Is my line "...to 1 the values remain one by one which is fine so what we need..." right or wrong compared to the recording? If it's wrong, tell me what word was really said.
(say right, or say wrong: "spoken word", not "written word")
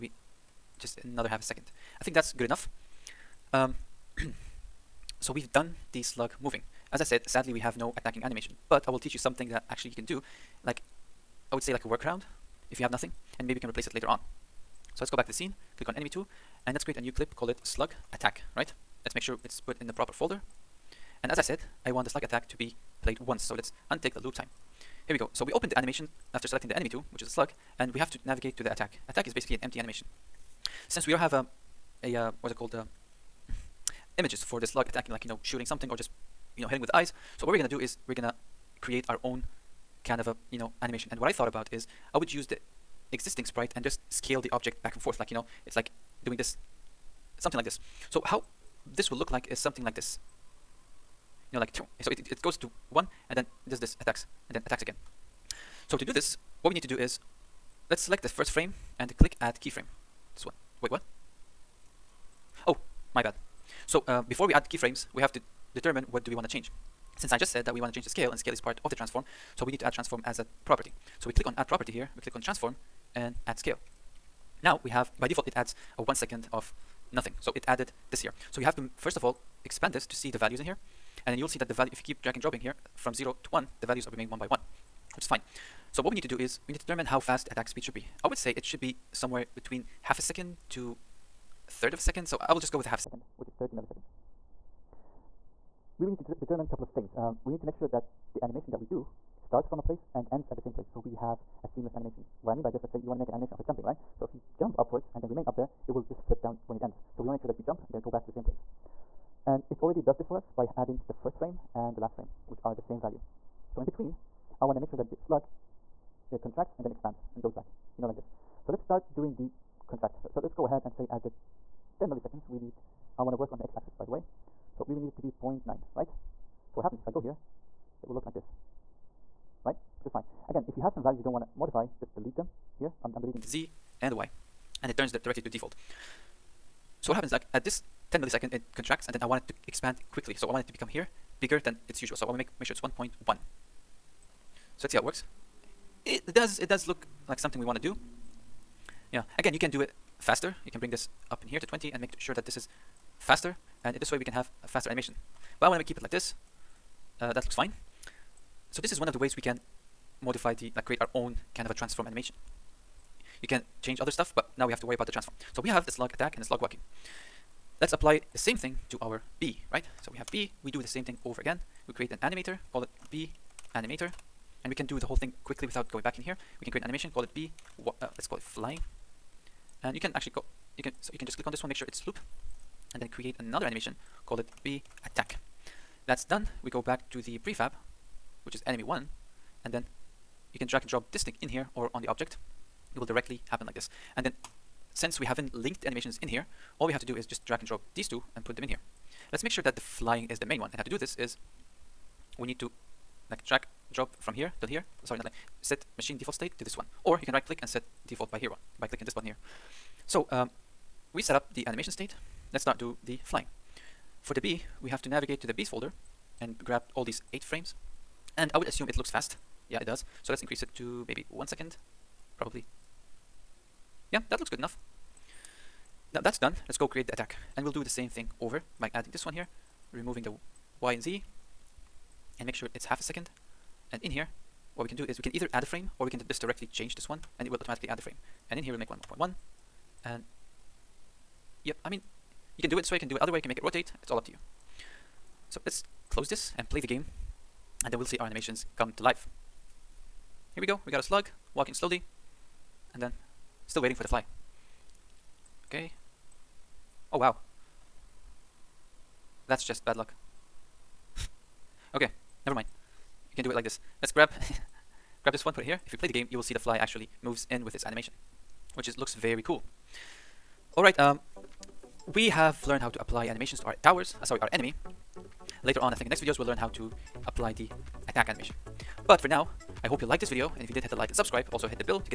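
right.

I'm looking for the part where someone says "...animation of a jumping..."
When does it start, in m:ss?
1:43.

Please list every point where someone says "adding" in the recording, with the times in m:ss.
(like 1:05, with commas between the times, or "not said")
1:50, 3:48.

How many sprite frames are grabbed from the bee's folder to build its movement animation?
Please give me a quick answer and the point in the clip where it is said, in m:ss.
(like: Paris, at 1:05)
8, at 3:37.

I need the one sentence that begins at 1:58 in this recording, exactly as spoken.
So let's start doing the contract.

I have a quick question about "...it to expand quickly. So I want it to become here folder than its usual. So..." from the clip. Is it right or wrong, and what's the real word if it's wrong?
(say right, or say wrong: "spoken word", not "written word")
wrong: "bigger", not "folder".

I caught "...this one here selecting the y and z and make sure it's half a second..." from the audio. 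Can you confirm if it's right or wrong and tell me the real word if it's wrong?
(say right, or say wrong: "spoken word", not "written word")
wrong: "removing", not "selecting".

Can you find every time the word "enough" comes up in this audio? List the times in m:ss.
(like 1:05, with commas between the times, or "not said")
0:02, 3:44.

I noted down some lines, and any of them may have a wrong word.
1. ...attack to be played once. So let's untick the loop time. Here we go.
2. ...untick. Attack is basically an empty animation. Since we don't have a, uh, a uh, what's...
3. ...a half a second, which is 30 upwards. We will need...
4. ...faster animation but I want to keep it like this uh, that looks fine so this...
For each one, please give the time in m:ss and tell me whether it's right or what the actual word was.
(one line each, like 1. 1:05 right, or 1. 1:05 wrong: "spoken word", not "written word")
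1. 0:22 right
2. 0:28 wrong: "attack", not "untick"
3. 1:32 wrong: "milliseconds", not "upwards"
4. 2:34 right.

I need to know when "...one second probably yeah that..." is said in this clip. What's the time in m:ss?
3:41.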